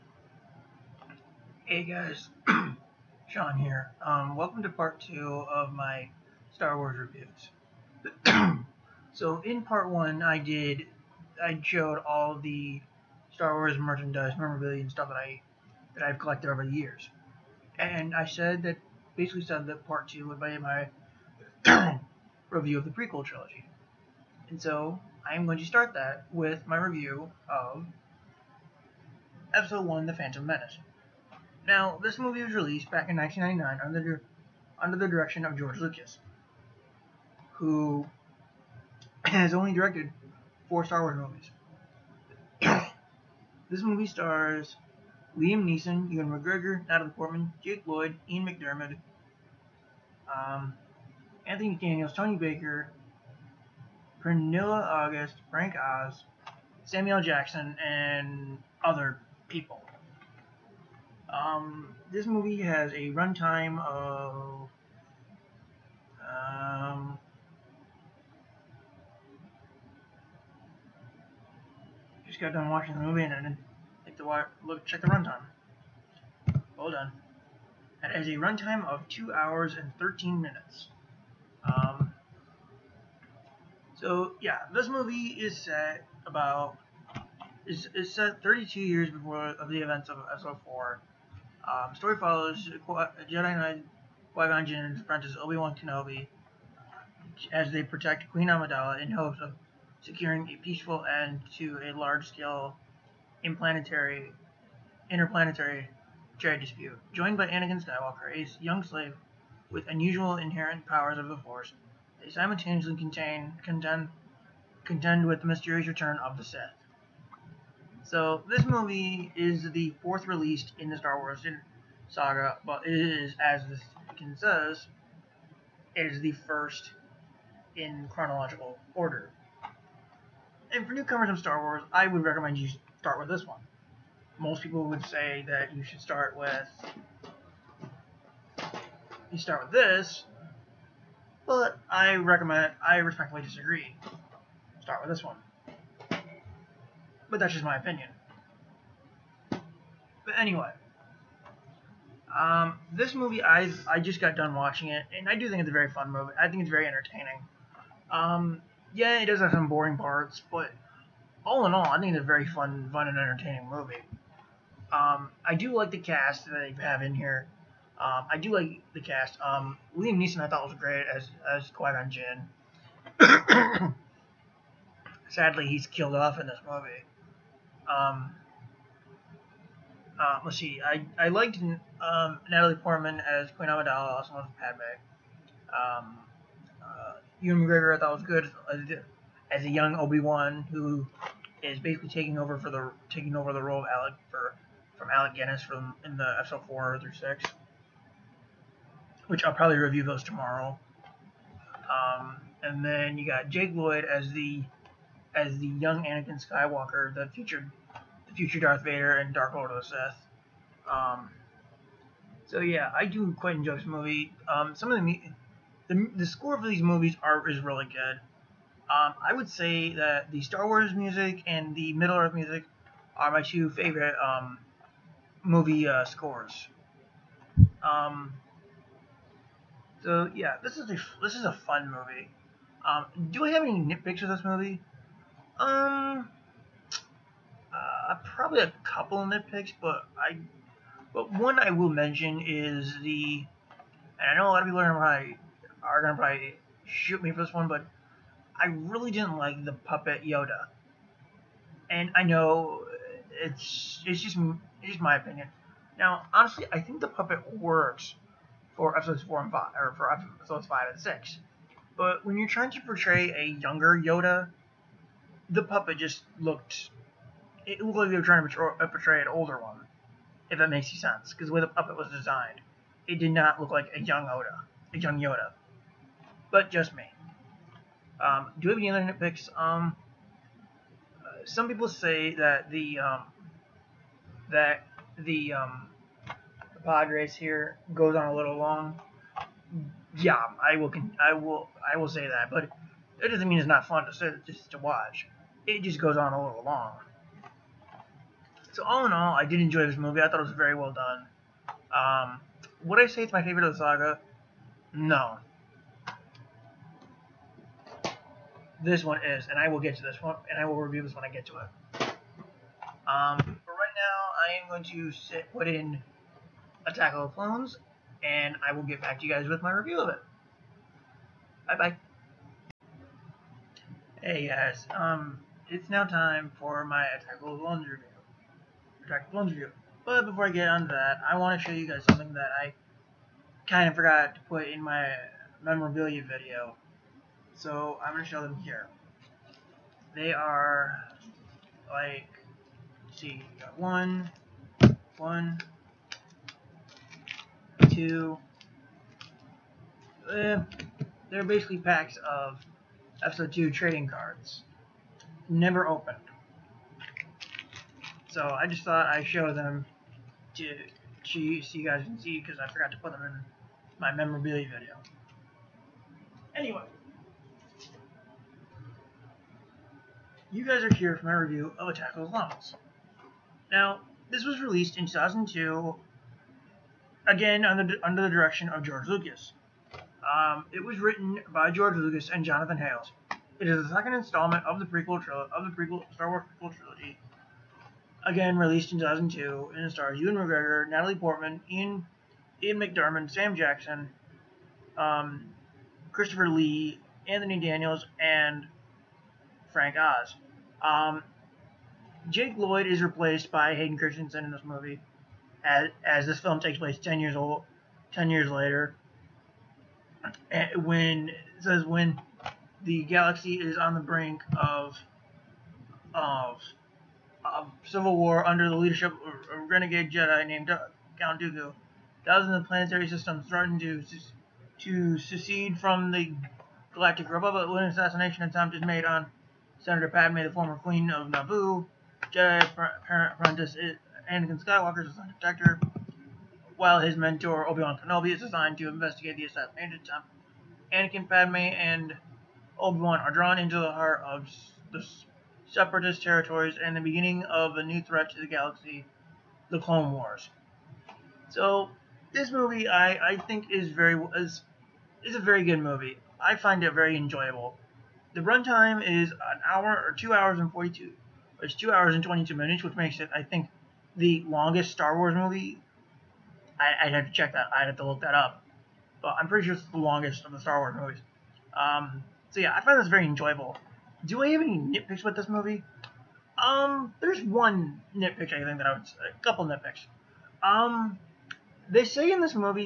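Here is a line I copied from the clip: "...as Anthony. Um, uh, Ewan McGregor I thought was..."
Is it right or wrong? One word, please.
wrong.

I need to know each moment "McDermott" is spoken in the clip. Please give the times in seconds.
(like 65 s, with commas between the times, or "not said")
48 s, 392 s.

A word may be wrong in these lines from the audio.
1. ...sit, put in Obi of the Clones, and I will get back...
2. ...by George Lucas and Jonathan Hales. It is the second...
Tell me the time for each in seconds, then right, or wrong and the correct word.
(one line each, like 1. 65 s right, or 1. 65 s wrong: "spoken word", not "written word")
1. 315 s wrong: "Attack", not "Obi"
2. 381 s right.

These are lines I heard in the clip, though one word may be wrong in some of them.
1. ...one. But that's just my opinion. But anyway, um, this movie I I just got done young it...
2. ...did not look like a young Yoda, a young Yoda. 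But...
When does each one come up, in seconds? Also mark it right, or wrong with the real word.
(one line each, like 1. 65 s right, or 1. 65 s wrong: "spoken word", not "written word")
1. 145 s wrong: "watching", not "young"
2. 273 s right.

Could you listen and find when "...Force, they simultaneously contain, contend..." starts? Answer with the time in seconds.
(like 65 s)
111 s.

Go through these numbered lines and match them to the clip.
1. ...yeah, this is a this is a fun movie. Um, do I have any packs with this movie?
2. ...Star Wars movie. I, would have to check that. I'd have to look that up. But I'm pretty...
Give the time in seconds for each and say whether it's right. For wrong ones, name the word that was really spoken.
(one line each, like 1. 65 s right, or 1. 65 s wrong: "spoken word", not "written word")
1. 230 s wrong: "nitpicks", not "packs"
2. 464 s right.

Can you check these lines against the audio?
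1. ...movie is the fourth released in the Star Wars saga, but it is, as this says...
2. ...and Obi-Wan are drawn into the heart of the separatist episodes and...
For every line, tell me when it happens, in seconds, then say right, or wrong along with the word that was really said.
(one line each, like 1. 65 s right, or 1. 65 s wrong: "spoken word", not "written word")
1. 118 s right
2. 441 s wrong: "territories", not "episodes".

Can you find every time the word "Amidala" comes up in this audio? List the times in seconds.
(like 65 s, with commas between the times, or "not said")
98 s, 183 s.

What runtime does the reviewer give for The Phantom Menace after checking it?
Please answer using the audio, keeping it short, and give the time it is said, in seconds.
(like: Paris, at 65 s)
2 hours 13 minutes, at 79 s.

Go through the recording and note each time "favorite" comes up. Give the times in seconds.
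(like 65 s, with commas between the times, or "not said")
223 s, 303 s.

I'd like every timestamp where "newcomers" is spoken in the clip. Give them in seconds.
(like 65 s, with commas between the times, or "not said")
130 s.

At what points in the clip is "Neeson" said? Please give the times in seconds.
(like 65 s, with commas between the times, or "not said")
45 s, 170 s.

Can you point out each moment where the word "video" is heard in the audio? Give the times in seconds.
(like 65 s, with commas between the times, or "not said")
336 s, 364 s.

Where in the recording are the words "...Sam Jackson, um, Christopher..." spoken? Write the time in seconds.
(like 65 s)
393 s.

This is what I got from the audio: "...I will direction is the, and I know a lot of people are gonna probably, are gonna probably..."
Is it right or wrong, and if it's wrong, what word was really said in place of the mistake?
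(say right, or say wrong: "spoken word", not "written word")
wrong: "mention", not "direction".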